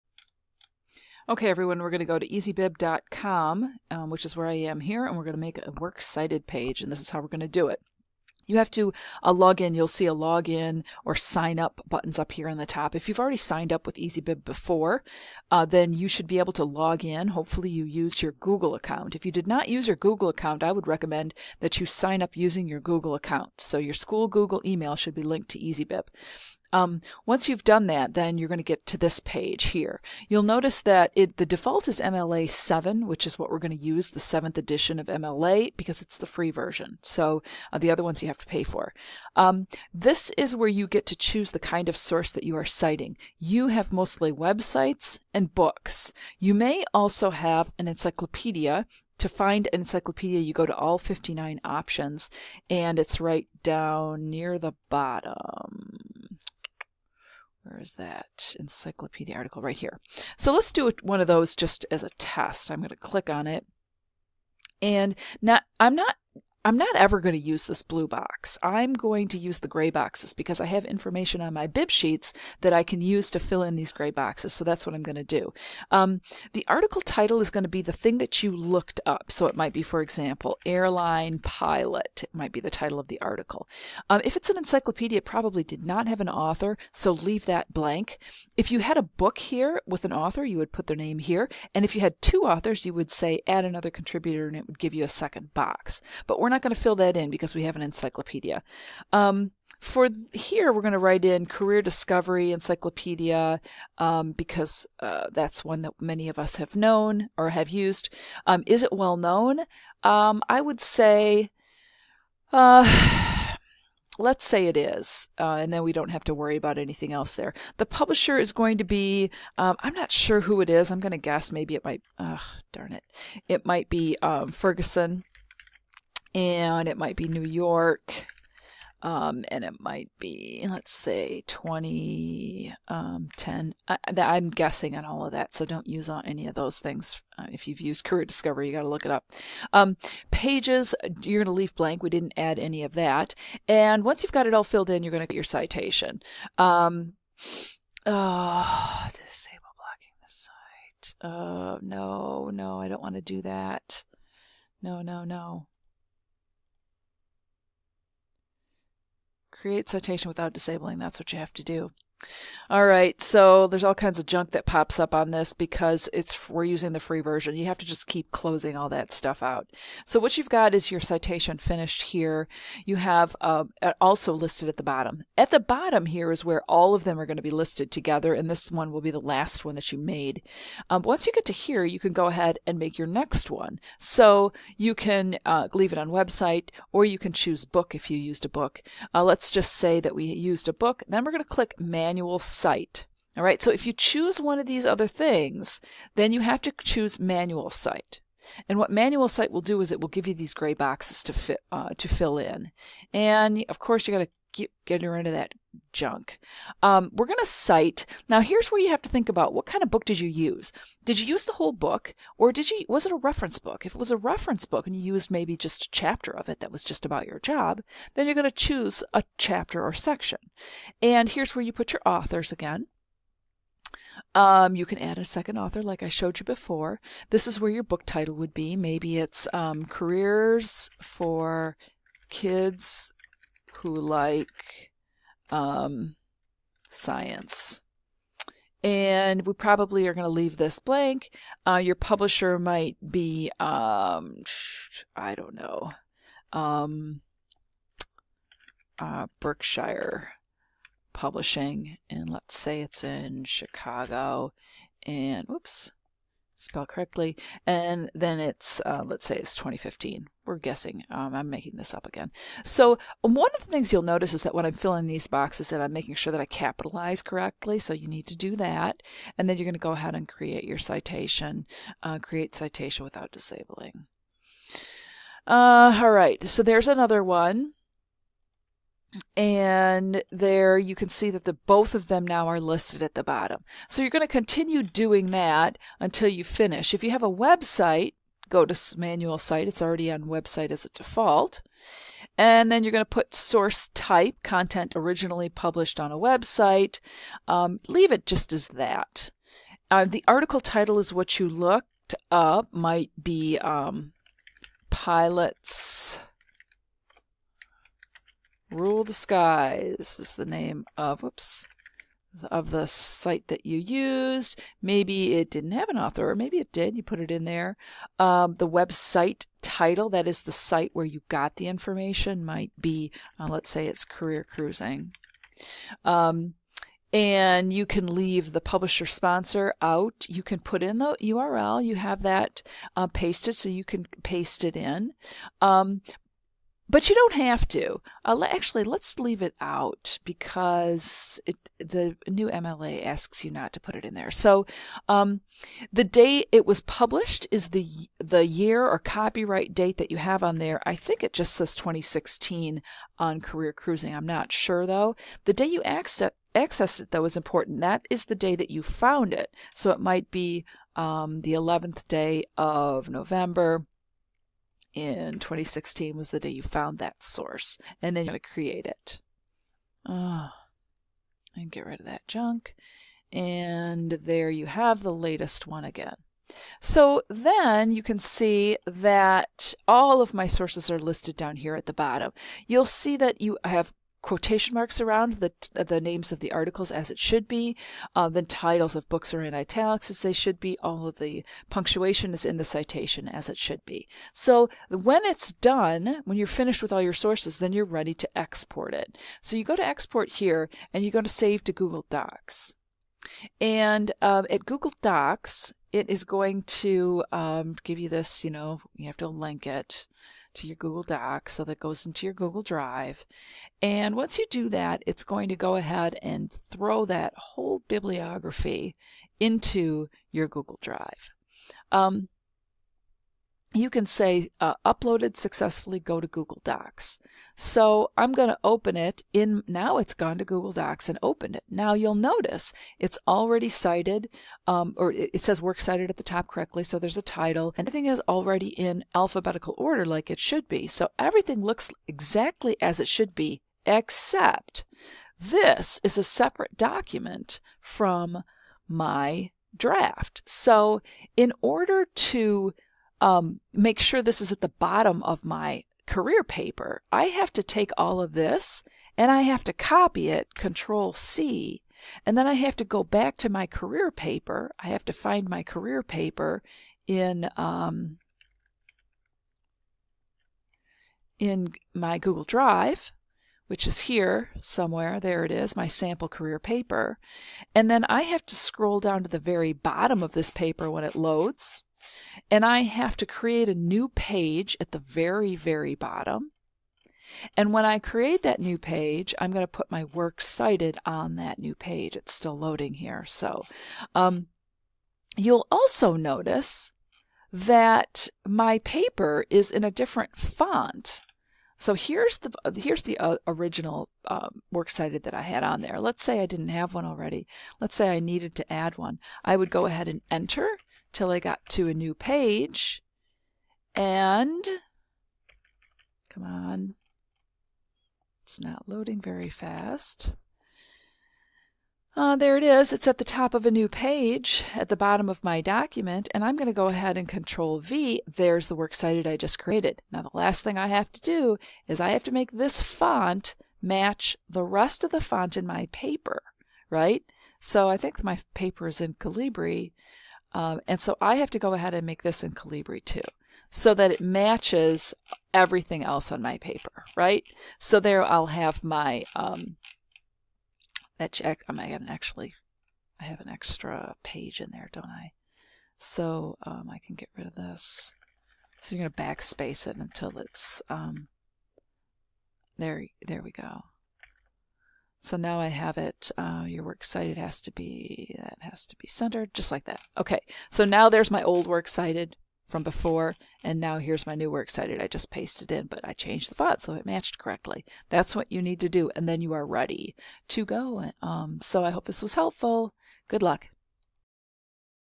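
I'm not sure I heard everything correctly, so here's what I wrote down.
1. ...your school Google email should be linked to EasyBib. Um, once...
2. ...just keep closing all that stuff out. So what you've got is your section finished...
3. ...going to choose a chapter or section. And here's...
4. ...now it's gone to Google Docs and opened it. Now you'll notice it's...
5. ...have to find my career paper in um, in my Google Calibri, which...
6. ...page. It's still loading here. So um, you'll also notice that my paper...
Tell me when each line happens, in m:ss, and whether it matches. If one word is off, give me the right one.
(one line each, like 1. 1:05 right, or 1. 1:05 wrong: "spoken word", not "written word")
1. 0:23 right
2. 2:47 wrong: "citation", not "section"
3. 3:38 right
4. 7:09 right
5. 7:44 wrong: "Drive", not "Calibri"
6. 8:11 right.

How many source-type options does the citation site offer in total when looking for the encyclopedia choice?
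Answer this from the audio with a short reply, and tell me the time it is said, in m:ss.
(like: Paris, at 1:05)
59, at 0:50.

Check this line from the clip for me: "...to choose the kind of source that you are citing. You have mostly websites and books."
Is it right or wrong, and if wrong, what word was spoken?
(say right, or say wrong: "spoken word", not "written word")
right.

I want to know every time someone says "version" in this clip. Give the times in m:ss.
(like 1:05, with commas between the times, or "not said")
0:36, 2:47.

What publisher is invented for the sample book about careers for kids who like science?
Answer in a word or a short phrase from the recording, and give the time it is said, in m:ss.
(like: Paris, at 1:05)
Berkshire Publishing, at 4:09.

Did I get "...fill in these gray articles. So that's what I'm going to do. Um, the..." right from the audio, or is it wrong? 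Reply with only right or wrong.
wrong.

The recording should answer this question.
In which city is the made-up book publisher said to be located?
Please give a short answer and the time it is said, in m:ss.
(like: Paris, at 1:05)
Chicago, at 4:13.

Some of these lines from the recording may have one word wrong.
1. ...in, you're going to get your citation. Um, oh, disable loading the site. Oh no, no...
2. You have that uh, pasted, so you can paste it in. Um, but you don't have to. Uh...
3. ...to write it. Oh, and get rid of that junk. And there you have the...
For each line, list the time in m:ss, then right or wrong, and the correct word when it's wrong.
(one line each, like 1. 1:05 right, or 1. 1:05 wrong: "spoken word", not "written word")
1. 2:24 wrong: "blocking", not "loading"
2. 5:31 right
3. 6:08 wrong: "create", not "write".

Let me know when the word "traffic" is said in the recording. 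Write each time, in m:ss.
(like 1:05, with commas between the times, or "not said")
not said.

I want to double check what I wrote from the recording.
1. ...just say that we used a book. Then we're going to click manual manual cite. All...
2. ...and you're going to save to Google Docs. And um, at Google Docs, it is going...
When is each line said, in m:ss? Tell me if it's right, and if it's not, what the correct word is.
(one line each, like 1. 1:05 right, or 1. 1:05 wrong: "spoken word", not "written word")
1. 3:09 right
2. 6:40 right.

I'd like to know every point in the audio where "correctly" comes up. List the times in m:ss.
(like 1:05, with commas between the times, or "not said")
4:16, 4:27, 7:16, 9:37.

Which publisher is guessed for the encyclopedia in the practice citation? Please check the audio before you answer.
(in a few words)
Ferguson.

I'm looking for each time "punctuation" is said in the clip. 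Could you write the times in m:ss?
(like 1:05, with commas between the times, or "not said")
6:31.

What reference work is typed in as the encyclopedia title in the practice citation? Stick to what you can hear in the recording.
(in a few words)
Career Discovery Encyclopedia.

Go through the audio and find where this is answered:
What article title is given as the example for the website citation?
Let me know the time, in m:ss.
5:04.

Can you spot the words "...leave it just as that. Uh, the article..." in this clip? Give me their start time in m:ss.
4:57.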